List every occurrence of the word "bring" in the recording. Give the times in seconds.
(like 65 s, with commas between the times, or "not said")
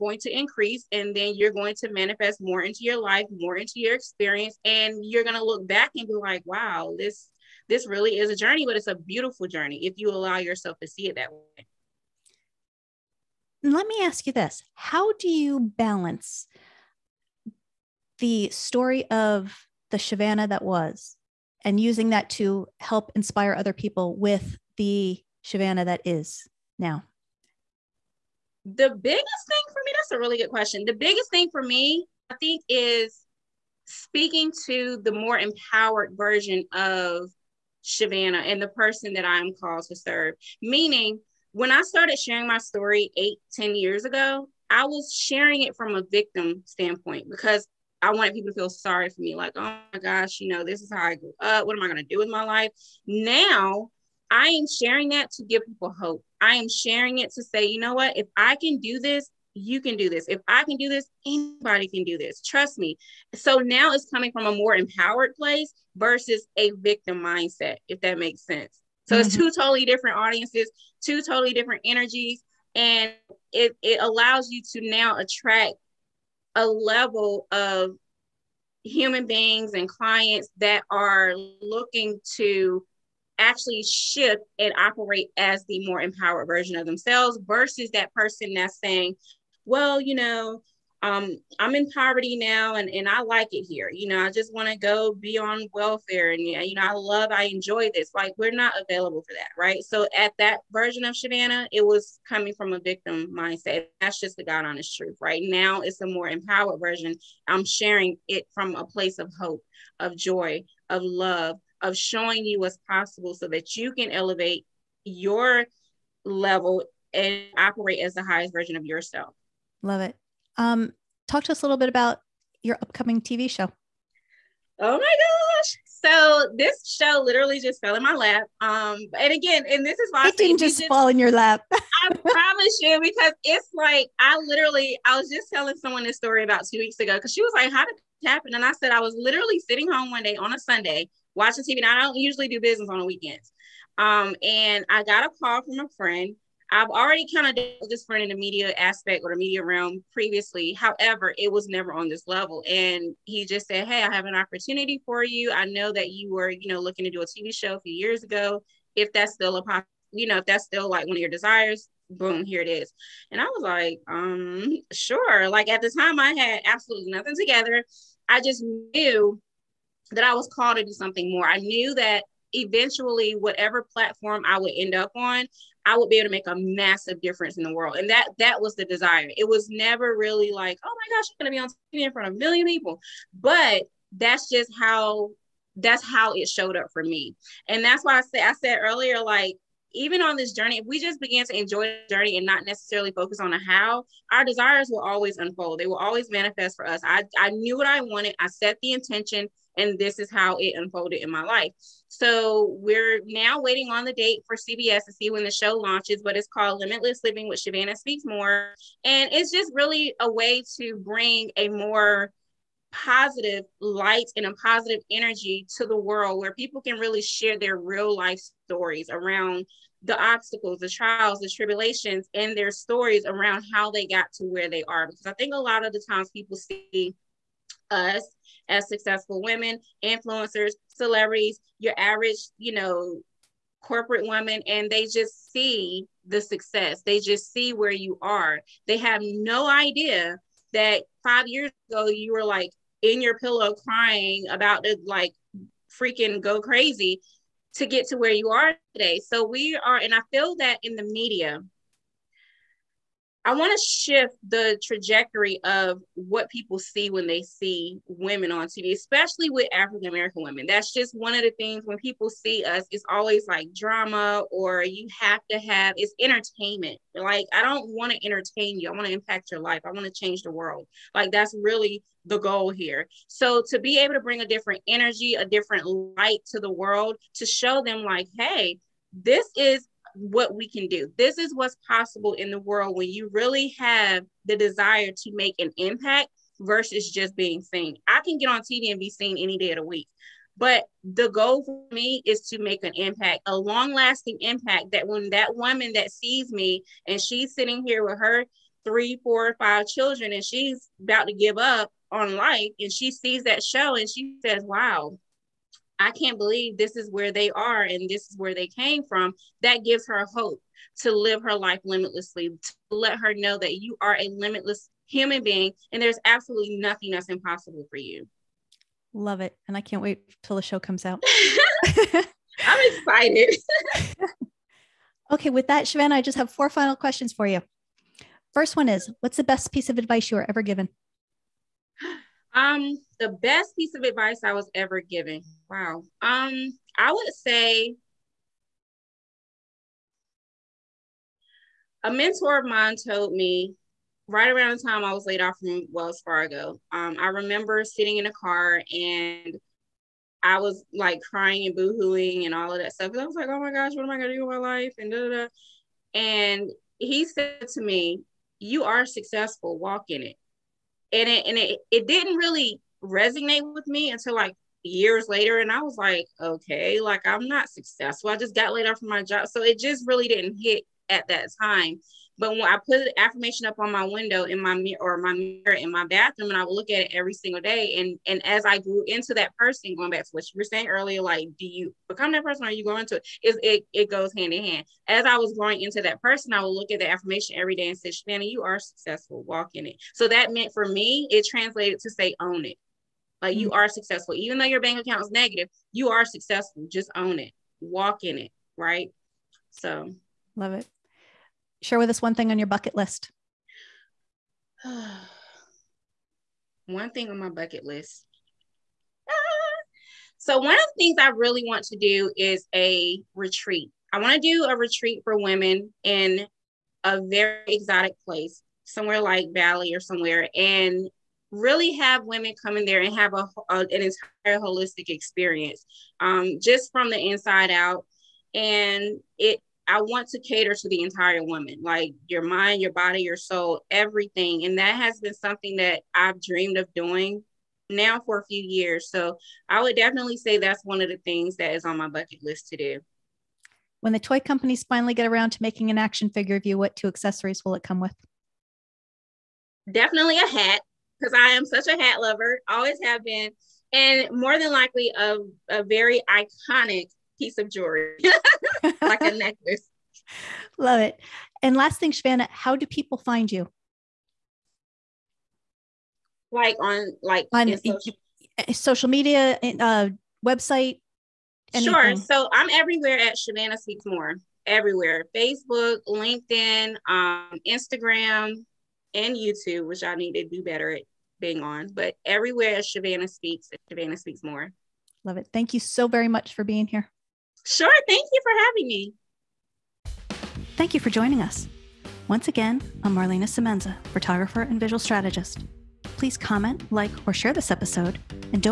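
210 s, 274 s.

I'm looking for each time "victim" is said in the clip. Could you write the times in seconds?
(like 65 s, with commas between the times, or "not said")
46 s, 66 s, 102 s.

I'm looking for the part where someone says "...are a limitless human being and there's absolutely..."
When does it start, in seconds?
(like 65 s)
314 s.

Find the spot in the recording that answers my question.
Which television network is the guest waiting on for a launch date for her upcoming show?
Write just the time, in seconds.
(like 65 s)
204 s.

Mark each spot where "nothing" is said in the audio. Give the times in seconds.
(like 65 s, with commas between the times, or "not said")
167 s, 316 s.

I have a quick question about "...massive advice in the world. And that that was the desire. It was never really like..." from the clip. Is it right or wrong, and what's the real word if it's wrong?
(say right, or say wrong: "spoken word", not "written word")
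wrong: "difference", not "advice".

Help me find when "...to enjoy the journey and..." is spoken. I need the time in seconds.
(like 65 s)
191 s.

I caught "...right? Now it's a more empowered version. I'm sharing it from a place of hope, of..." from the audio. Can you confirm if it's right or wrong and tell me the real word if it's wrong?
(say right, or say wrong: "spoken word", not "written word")
right.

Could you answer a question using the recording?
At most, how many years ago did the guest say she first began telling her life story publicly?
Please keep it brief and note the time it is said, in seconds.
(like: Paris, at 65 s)
10, at 43 s.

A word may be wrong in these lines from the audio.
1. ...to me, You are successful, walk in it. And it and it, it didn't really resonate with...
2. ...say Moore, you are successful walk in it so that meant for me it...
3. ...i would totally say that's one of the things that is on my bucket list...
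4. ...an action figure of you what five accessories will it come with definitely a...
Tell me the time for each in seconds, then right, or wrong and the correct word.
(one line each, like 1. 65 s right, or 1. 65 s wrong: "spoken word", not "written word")
1. 357 s right
2. 387 s wrong: "Shanna", not "Moore"
3. 439 s wrong: "definitely", not "totally"
4. 445 s wrong: "two", not "five".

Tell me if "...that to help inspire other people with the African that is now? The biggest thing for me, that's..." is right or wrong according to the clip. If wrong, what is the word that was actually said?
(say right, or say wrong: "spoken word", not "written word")
wrong: "Shavannah", not "African".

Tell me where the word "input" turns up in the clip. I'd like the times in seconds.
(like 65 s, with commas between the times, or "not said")
not said.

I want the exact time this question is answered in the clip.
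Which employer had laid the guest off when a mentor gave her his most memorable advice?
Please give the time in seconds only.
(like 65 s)
345 s.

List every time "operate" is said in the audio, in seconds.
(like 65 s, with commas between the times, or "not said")
84 s, 117 s.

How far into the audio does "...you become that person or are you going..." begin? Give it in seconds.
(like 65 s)
381 s.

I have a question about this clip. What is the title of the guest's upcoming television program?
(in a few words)
Limitless Living.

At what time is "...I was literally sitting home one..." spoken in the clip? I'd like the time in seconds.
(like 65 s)
138 s.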